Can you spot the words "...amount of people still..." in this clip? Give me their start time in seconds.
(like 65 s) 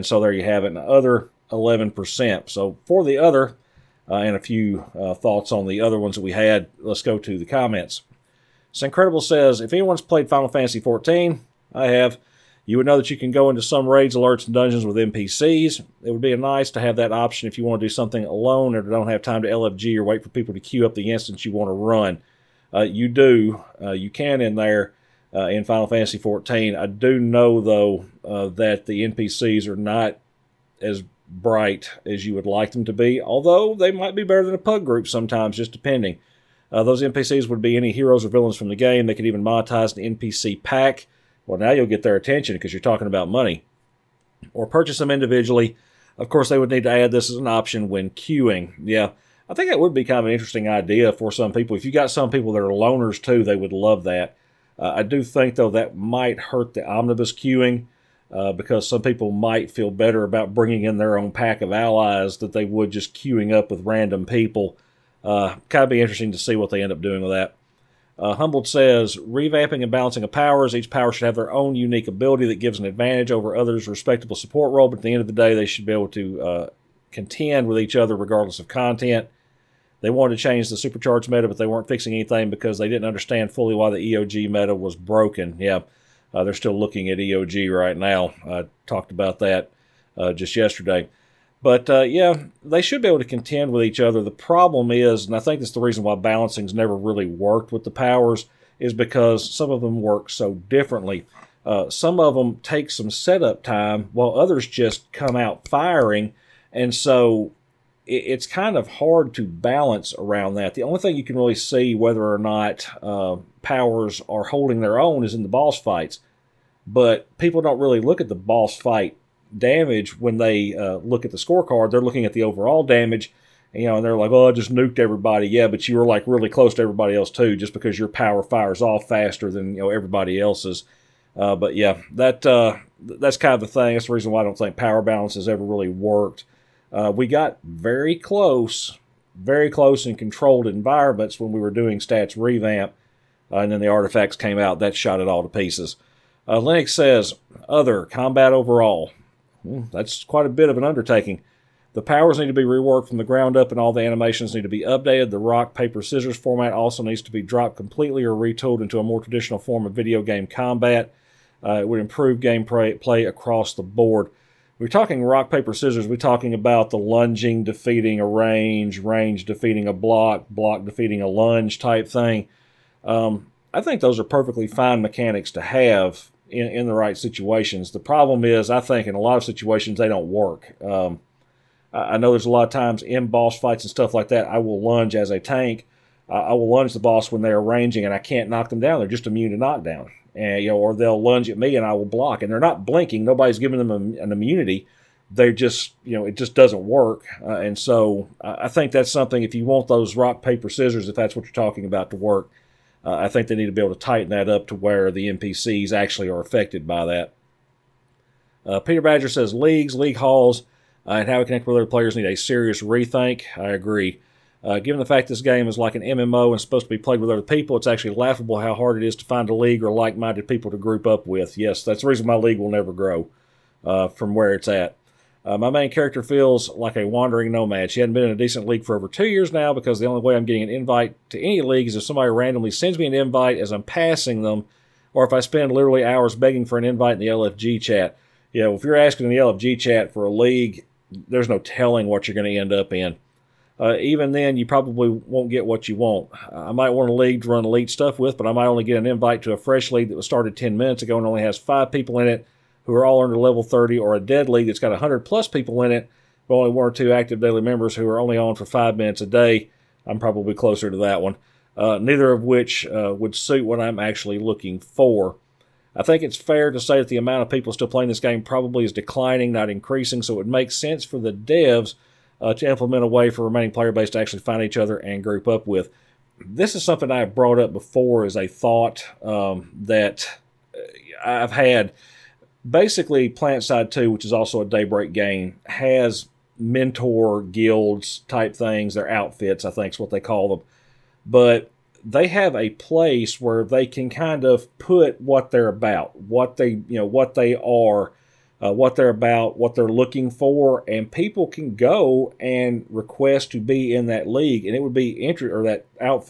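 267 s.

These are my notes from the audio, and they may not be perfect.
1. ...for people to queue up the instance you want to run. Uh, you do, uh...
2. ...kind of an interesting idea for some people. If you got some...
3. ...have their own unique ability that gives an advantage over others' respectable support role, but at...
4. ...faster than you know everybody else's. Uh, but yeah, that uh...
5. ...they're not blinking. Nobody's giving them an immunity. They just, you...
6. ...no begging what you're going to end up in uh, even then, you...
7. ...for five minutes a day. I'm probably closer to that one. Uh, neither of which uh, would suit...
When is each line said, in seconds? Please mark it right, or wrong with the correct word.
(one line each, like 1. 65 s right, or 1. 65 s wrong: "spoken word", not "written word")
1. 20 s right
2. 50 s right
3. 71 s right
4. 129 s right
5. 192 s right
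6. 241 s wrong: "telling", not "begging"
7. 258 s right.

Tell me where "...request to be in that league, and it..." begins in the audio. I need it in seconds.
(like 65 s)
302 s.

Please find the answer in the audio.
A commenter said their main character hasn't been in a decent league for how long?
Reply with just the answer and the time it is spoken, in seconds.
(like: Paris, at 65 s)
over two years, at 228 s.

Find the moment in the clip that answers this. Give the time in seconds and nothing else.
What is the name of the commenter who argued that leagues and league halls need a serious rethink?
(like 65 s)
208 s.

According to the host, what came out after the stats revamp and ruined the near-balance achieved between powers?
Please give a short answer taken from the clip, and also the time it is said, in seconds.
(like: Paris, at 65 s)
the artifacts, at 143 s.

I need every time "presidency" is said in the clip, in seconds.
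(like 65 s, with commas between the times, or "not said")
not said.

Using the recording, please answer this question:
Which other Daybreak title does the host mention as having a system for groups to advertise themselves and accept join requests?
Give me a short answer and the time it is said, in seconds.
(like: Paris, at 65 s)
PlanetSide 2, at 283 s.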